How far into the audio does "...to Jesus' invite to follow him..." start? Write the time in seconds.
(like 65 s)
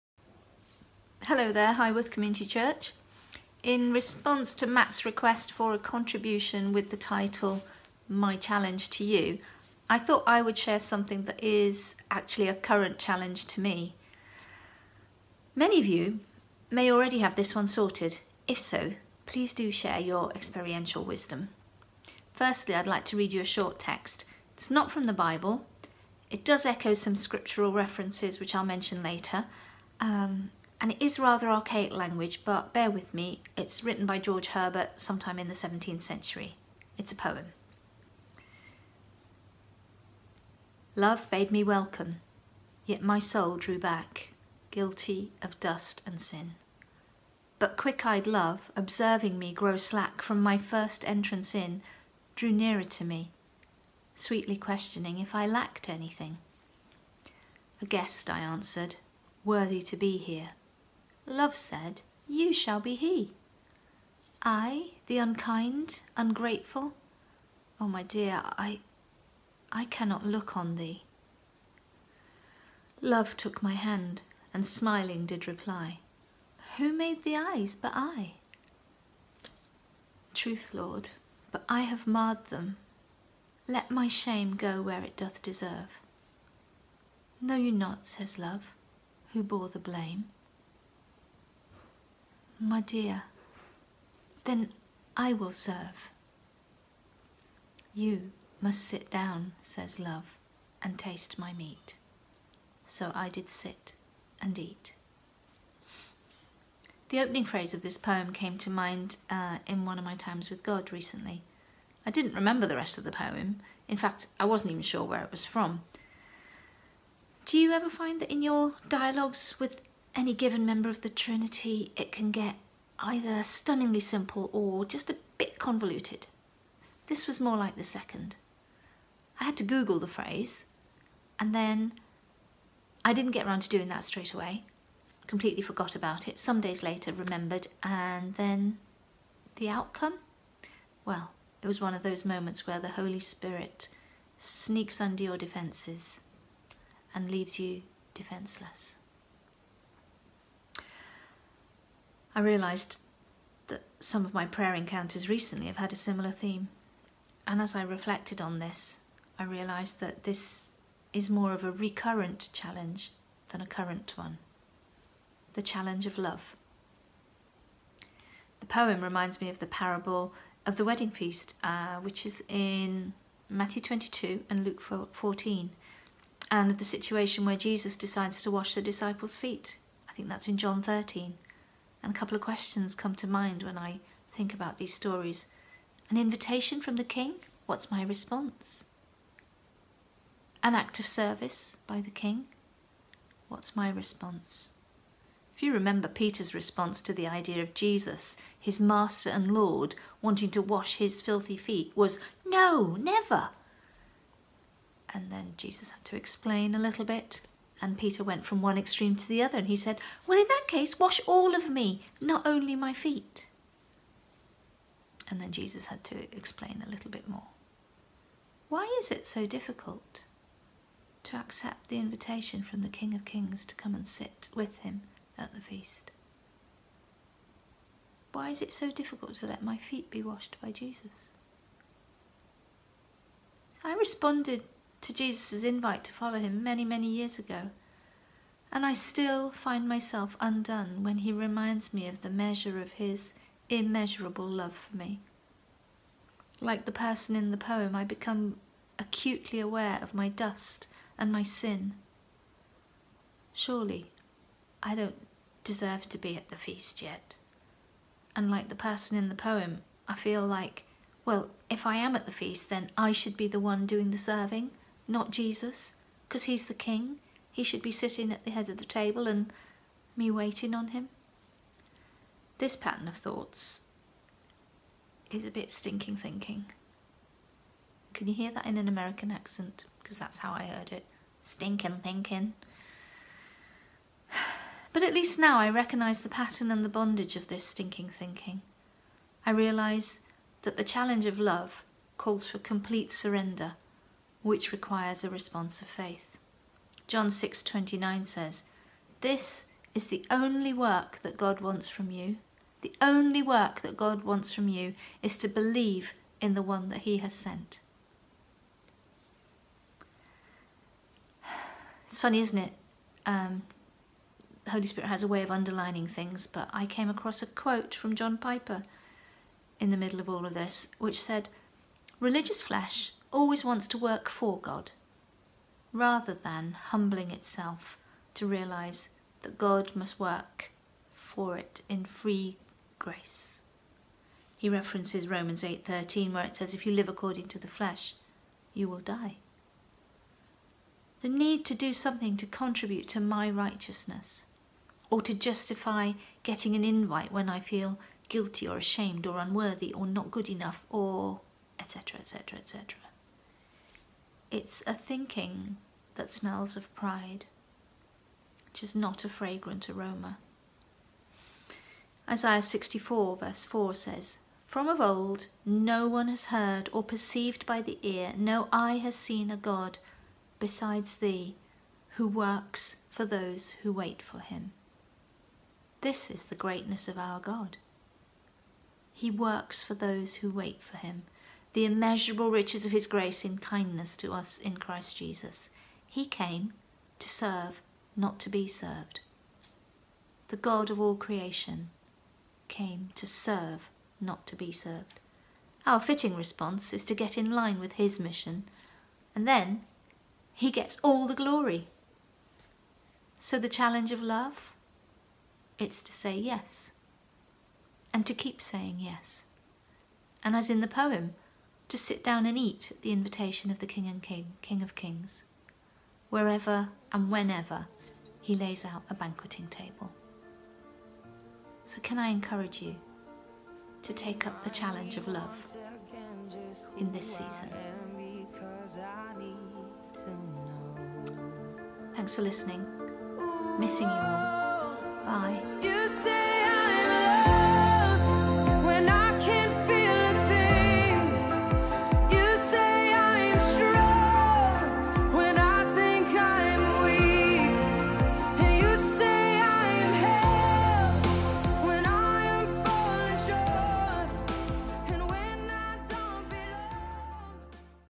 235 s.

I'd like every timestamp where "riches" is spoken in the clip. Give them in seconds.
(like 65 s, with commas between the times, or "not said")
382 s.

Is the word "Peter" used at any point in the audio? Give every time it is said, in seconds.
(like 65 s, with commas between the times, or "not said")
196 s, 207 s.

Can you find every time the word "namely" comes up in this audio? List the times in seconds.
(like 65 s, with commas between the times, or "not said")
not said.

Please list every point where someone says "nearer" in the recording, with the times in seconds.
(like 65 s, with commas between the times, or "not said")
52 s.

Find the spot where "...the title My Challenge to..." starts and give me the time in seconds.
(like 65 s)
6 s.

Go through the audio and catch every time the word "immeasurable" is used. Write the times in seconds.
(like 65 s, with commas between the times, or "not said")
243 s, 381 s.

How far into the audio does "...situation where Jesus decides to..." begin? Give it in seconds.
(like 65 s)
176 s.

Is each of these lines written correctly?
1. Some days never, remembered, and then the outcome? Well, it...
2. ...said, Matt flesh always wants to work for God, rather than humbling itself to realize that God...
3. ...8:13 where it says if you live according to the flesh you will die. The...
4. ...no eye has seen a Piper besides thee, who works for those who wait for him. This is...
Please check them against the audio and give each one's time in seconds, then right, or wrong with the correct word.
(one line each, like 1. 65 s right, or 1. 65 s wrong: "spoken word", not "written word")
1. 136 s wrong: "later", not "never"
2. 321 s wrong: "Religious", not "Matt"
3. 335 s right
4. 368 s wrong: "God", not "Piper".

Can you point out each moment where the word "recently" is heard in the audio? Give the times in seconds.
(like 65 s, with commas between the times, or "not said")
110 s, 155 s.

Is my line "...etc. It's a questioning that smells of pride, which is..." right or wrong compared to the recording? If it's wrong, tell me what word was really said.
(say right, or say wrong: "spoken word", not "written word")
wrong: "thinking", not "questioning".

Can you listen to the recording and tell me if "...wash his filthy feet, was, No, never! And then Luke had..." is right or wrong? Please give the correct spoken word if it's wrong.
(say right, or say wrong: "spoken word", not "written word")
wrong: "Jesus", not "Luke".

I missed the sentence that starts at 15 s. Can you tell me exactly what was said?
Many of you may already have this one sorted.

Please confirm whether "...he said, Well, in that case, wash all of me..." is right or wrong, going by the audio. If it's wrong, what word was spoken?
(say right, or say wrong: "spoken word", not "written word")
right.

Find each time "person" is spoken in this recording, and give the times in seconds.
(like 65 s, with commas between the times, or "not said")
246 s, 258 s.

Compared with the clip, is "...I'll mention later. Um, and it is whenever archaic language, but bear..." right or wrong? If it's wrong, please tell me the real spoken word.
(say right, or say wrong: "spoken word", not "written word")
wrong: "rather", not "whenever".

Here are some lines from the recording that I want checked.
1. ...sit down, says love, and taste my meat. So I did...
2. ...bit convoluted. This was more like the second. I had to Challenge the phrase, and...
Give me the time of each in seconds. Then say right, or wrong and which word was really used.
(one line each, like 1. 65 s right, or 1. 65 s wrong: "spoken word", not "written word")
1. 98 s right
2. 125 s wrong: "Google", not "Challenge".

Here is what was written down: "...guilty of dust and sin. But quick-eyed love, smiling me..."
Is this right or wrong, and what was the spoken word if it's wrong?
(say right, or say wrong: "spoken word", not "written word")
wrong: "observing", not "smiling".